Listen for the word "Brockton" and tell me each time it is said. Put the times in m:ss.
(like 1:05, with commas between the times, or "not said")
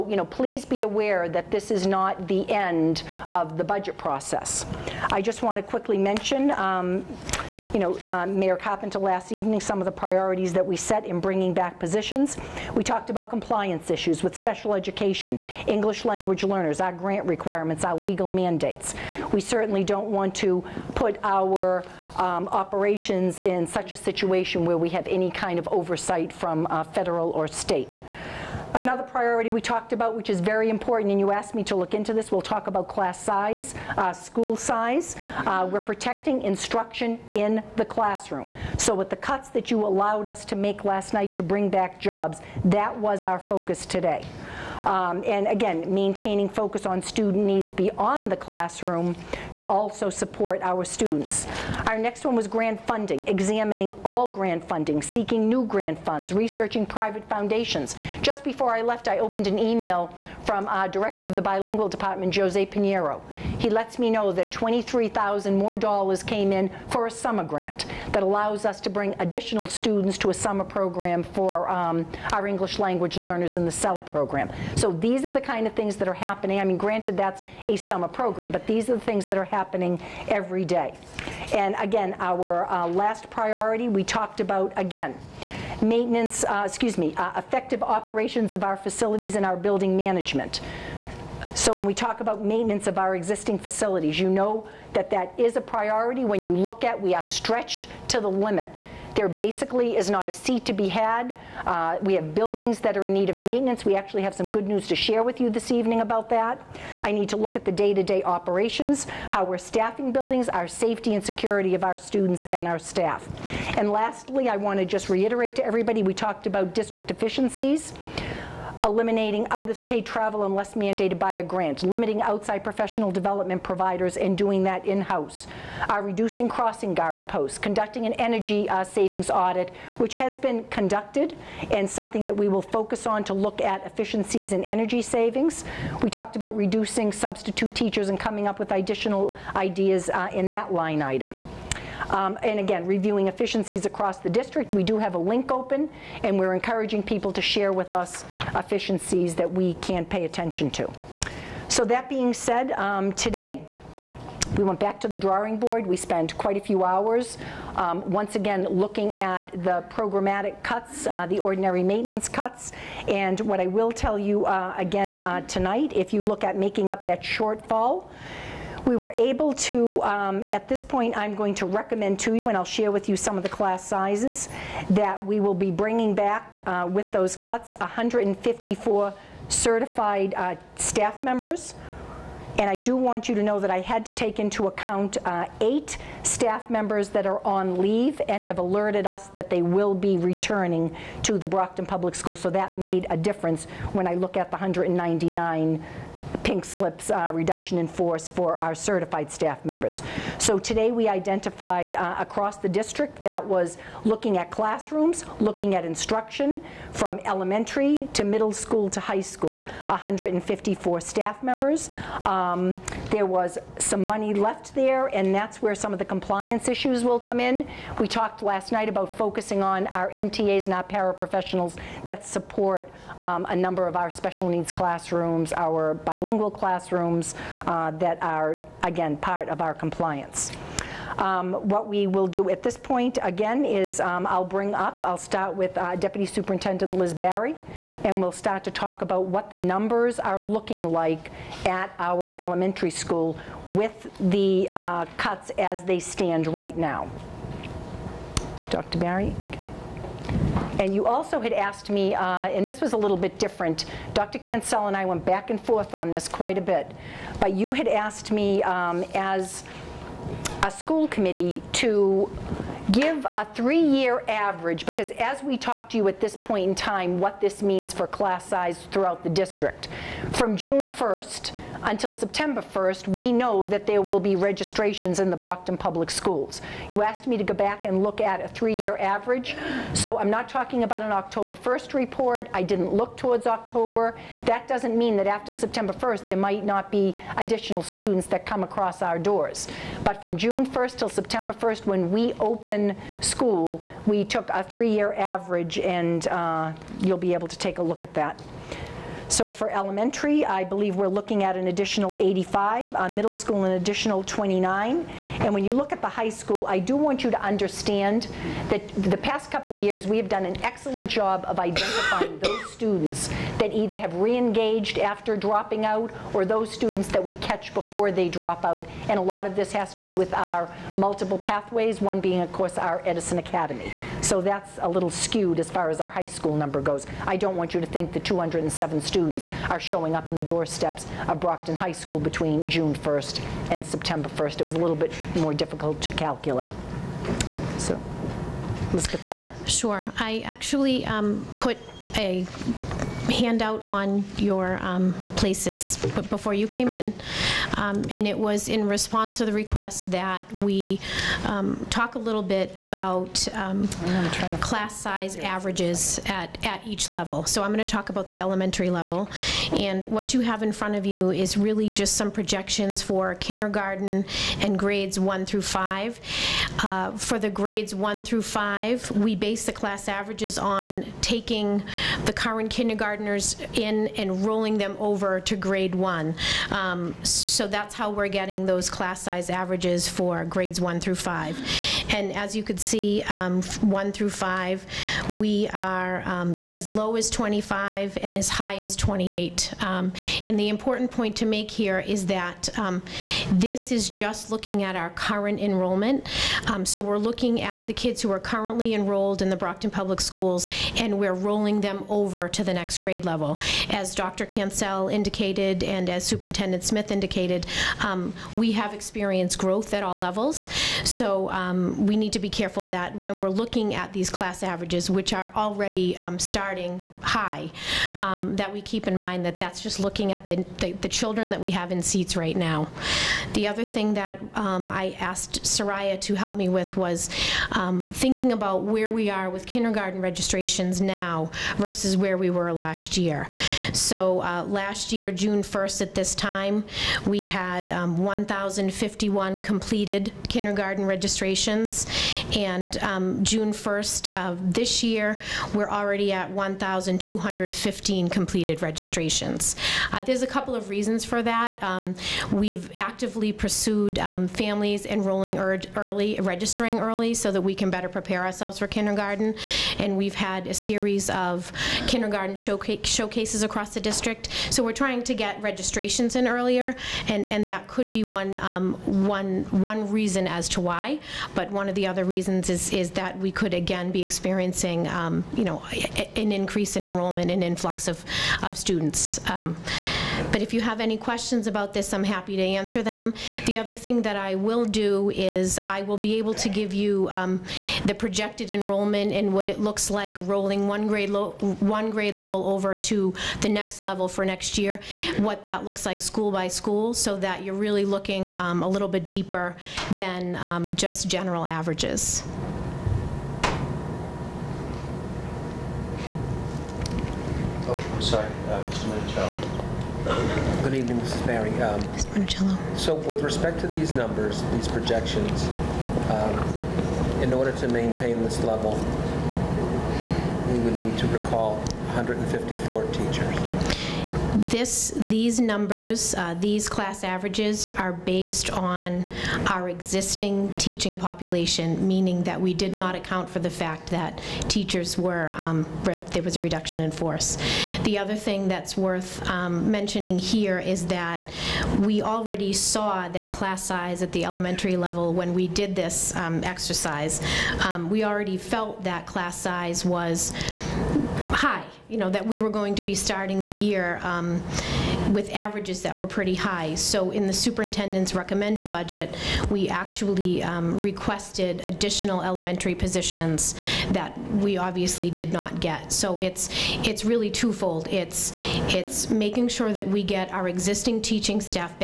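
3:11, 4:35, 5:31, 6:39.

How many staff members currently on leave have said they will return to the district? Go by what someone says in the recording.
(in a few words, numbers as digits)
8.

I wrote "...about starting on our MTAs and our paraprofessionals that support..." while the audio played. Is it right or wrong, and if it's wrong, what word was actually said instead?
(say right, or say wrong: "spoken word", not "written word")
wrong: "focusing", not "starting".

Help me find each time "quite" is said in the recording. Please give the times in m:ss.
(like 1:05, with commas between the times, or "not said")
2:36, 4:16.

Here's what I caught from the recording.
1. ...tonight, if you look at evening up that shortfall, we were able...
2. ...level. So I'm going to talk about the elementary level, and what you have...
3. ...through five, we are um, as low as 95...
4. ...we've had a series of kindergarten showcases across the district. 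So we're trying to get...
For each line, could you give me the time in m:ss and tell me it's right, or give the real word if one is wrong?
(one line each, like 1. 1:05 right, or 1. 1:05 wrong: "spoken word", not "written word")
1. 2:45 wrong: "making", not "evening"
2. 5:57 right
3. 6:24 wrong: "25", not "95"
4. 7:40 right.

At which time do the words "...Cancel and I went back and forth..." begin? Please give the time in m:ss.
4:14.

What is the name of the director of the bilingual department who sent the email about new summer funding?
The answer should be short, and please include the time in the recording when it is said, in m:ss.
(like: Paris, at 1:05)
Jose Pinheiro, at 1:02.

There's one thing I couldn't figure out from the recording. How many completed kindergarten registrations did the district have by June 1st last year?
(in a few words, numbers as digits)
1,051.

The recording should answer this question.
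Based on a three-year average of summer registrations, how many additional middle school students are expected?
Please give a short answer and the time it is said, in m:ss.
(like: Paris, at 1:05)
29, at 5:04.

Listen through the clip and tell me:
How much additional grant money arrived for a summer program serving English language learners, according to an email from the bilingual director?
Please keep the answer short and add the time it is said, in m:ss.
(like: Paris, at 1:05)
$23,000, at 1:04.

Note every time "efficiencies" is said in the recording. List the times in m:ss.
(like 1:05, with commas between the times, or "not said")
1:57, 2:13, 2:23, 2:28.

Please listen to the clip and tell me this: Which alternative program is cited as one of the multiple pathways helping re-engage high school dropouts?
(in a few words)
Edison Academy.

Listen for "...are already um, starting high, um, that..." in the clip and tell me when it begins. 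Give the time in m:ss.
6:55.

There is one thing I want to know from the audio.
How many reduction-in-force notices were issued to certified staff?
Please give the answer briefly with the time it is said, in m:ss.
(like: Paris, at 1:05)
199, at 3:14.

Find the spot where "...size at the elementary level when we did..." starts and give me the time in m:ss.
9:03.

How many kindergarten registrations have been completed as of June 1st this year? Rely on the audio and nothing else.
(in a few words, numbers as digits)
1,215.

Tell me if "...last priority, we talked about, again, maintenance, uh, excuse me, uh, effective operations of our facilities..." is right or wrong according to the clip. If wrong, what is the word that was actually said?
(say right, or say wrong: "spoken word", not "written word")
right.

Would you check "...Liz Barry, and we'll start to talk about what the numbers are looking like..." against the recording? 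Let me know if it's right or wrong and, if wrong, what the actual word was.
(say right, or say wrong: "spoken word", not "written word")
right.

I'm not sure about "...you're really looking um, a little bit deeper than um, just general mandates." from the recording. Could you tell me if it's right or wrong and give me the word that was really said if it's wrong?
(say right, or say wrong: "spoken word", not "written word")
wrong: "averages", not "mandates".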